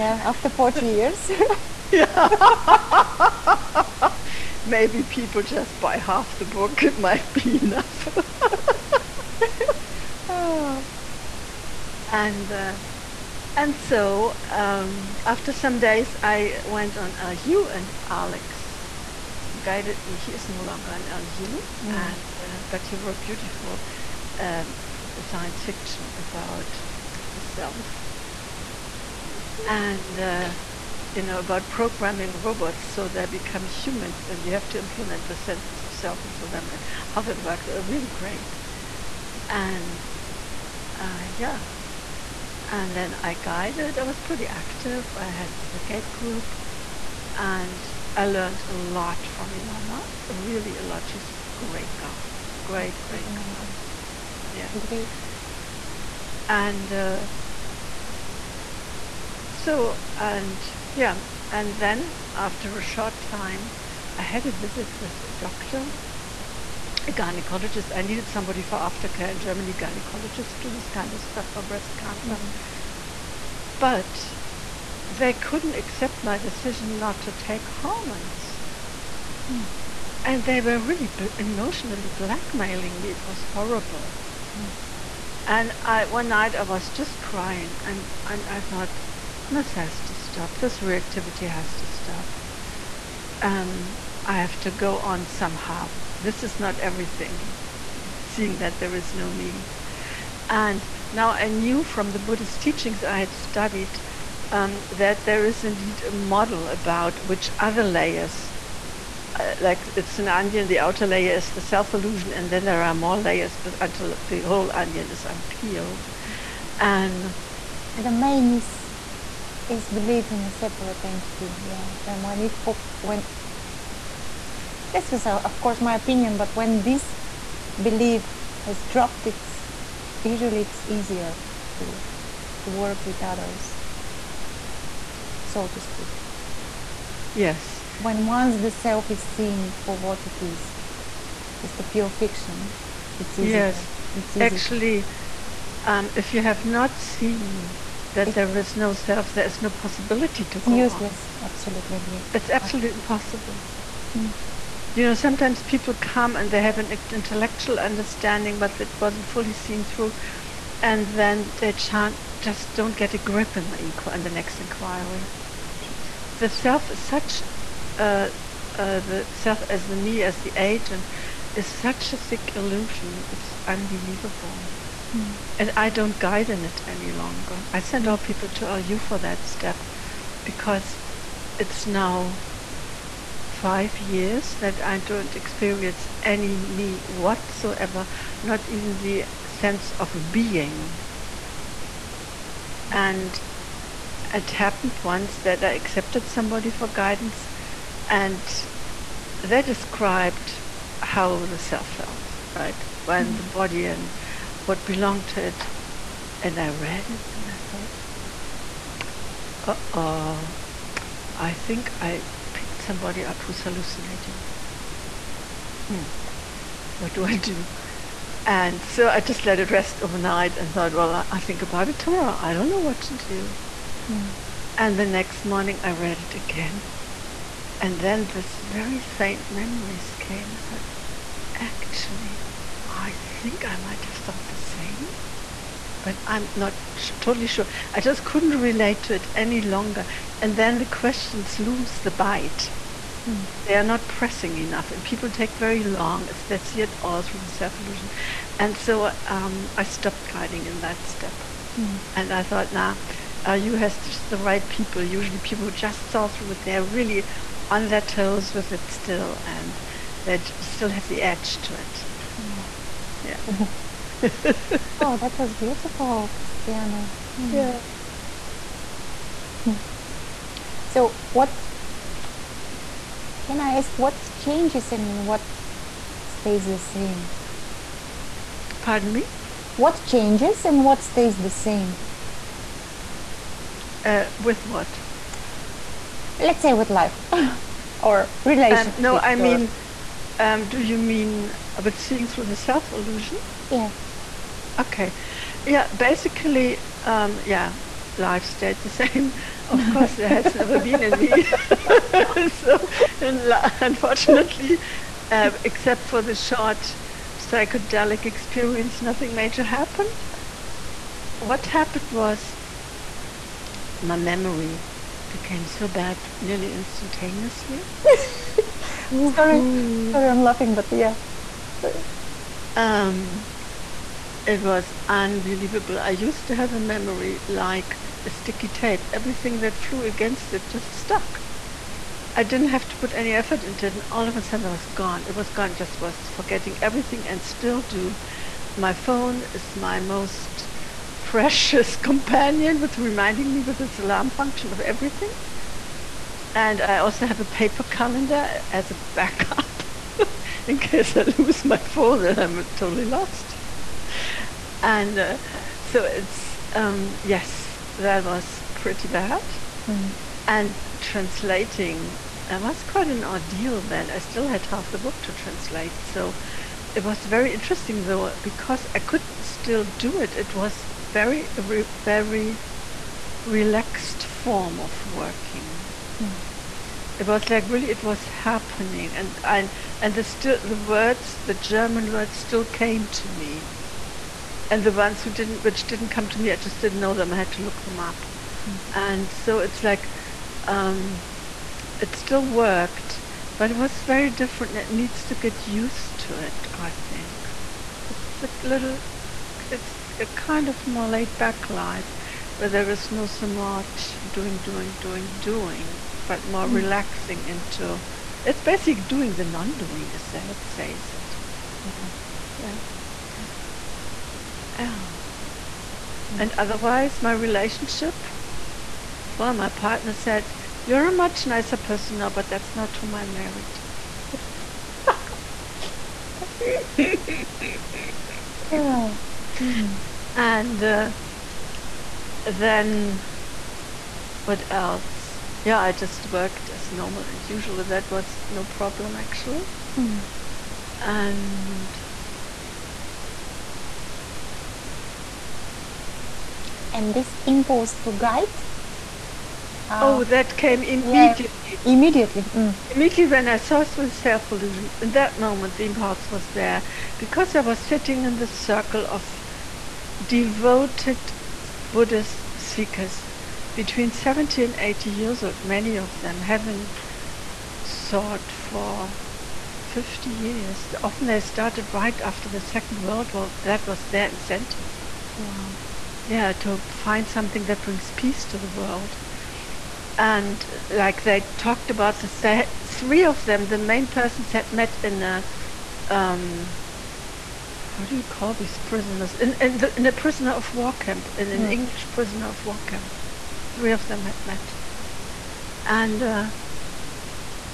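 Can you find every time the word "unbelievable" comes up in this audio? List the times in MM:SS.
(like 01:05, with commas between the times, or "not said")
02:53, 05:25.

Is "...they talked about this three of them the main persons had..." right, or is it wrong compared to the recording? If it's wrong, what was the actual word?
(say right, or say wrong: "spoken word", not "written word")
right.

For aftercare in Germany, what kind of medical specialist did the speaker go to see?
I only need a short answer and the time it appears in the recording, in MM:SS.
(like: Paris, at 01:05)
Gynecologist, at 01:07.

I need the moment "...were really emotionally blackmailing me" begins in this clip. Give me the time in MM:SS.
01:20.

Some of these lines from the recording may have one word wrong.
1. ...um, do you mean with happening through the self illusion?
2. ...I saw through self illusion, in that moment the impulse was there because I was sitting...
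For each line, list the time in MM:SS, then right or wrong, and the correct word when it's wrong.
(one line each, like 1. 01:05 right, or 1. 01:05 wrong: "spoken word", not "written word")
1. 04:50 wrong: "seeing", not "happening"
2. 07:33 right.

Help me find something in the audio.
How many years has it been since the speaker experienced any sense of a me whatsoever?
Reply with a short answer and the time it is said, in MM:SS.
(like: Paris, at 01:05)
5, at 03:03.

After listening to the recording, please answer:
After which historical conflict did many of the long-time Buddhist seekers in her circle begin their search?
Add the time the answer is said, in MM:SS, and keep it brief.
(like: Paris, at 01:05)
Second World War, at 07:52.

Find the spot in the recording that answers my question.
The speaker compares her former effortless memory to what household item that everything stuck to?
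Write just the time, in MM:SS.
05:28.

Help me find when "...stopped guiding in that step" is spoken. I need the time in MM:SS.
04:09.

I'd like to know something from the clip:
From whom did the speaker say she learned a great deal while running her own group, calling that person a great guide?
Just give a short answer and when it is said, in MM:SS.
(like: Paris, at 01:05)
Ilona, at 00:49.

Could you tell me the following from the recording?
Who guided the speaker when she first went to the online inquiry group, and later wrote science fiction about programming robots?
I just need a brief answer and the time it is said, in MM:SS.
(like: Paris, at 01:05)
Alex, at 00:18.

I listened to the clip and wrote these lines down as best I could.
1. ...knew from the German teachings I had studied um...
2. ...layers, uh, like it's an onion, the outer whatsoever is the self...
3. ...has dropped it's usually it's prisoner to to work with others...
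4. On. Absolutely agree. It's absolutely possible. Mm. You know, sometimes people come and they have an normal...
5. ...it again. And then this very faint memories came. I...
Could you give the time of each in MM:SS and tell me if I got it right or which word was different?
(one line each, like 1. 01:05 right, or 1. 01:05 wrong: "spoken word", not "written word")
1. 01:41 wrong: "Buddhist", not "German"
2. 01:47 wrong: "layer", not "whatsoever"
3. 02:08 wrong: "easier", not "prisoner"
4. 02:31 wrong: "intellectual", not "normal"
5. 03:46 right.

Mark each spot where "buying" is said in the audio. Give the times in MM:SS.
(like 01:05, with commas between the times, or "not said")
not said.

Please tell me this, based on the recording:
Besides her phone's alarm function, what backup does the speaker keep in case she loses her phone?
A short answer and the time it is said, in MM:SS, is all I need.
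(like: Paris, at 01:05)
Paper calendar, at 05:47.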